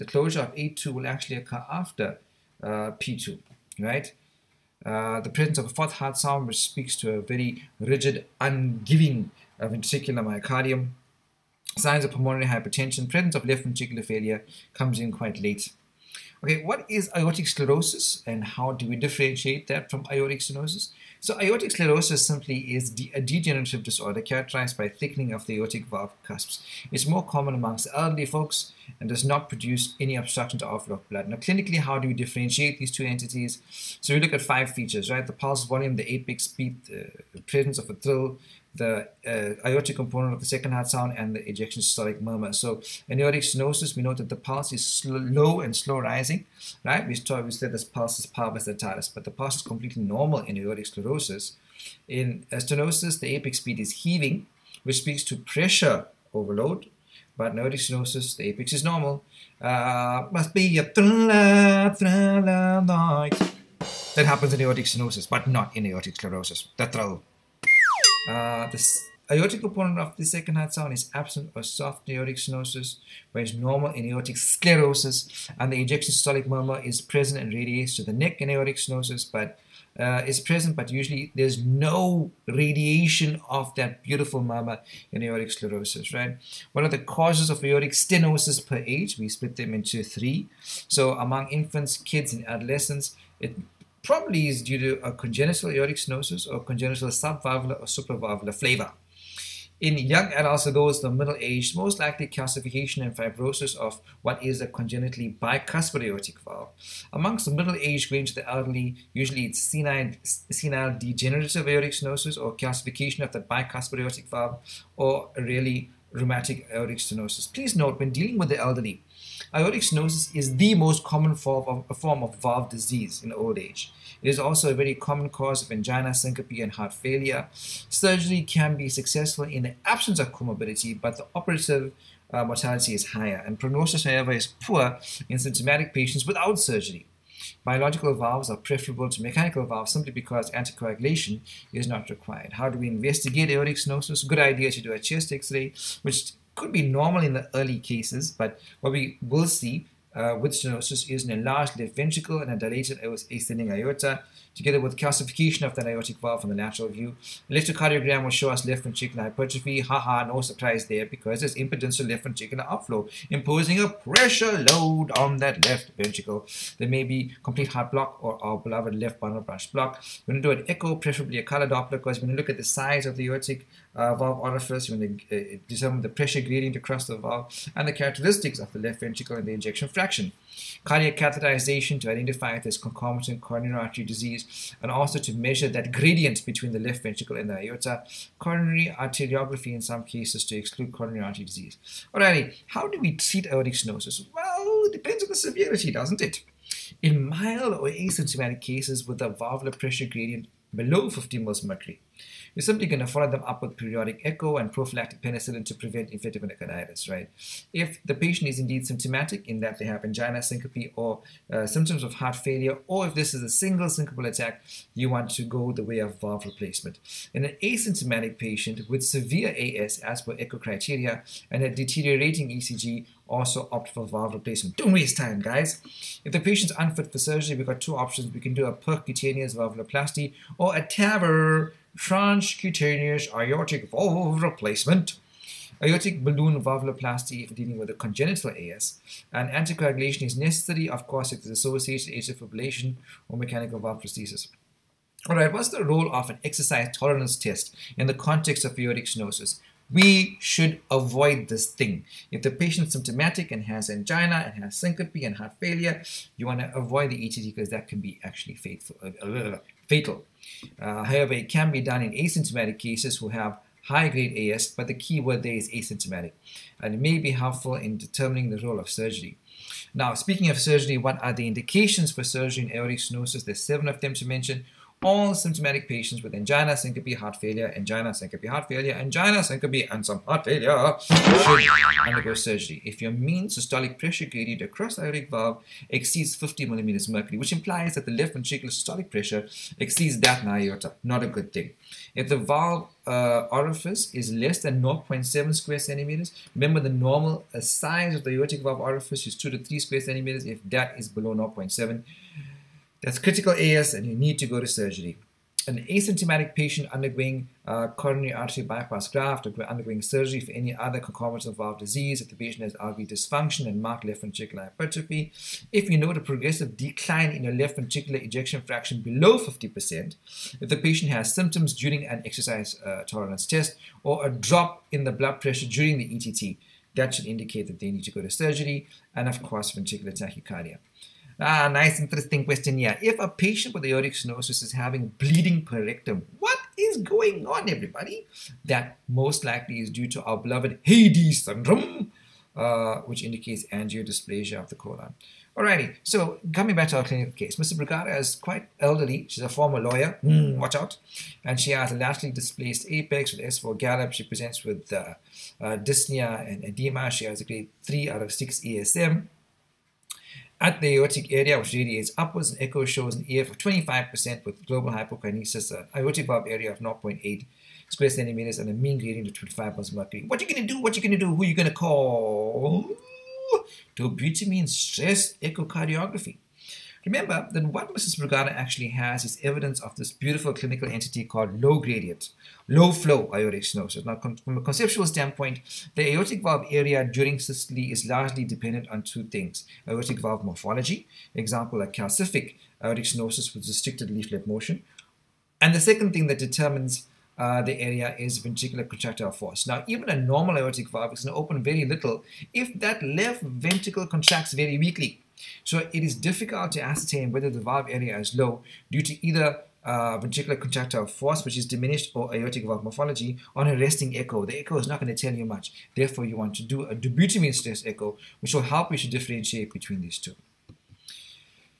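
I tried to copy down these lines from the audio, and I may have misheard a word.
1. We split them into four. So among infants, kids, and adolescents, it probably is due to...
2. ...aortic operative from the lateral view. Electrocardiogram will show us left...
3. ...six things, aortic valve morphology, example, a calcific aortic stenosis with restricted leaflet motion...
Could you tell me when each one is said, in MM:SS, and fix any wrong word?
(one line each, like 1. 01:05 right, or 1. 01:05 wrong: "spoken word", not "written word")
1. 01:29 wrong: "three", not "four"
2. 02:35 wrong: "valve", not "operative"
3. 06:29 wrong: "two", not "six".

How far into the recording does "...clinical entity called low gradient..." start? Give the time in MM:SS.
06:20.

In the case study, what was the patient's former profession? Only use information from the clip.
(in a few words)
Lawyer.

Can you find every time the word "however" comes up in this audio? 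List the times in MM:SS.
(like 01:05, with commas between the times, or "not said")
02:14, 04:21.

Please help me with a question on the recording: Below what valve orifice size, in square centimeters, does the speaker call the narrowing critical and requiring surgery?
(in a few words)
0.7.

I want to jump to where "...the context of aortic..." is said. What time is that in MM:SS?
04:08.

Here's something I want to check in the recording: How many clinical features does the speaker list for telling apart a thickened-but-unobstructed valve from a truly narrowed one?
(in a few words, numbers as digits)
5.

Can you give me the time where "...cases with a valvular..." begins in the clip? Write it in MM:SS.
03:18.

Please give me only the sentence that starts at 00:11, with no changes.
Signs of pulmonary hypertension, presence of left ventricular failure comes in quite late.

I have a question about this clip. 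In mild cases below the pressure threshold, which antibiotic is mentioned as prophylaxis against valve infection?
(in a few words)
Penicillin.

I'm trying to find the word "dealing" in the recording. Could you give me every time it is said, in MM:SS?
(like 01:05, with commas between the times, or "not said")
01:58, 03:57.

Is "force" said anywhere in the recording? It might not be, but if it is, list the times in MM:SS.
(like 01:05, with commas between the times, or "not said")
06:39, 06:51.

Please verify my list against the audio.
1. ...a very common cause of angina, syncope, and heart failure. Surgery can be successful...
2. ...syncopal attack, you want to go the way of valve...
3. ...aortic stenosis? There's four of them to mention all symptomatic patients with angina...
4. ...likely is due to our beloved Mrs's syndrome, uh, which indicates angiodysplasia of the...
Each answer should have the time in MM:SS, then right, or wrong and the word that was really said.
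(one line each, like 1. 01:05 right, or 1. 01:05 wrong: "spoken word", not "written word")
1. 02:04 right
2. 03:33 right
3. 04:32 wrong: "seven", not "four"
4. 05:39 wrong: "Heyde", not "Mrs".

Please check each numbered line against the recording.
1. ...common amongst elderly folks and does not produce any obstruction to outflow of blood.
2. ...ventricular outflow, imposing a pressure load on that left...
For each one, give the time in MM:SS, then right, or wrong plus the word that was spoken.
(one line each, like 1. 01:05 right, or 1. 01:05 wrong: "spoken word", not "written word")
1. 00:27 right
2. 02:42 right.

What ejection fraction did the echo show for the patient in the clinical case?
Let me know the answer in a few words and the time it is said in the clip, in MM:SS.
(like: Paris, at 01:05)
25%, at 06:03.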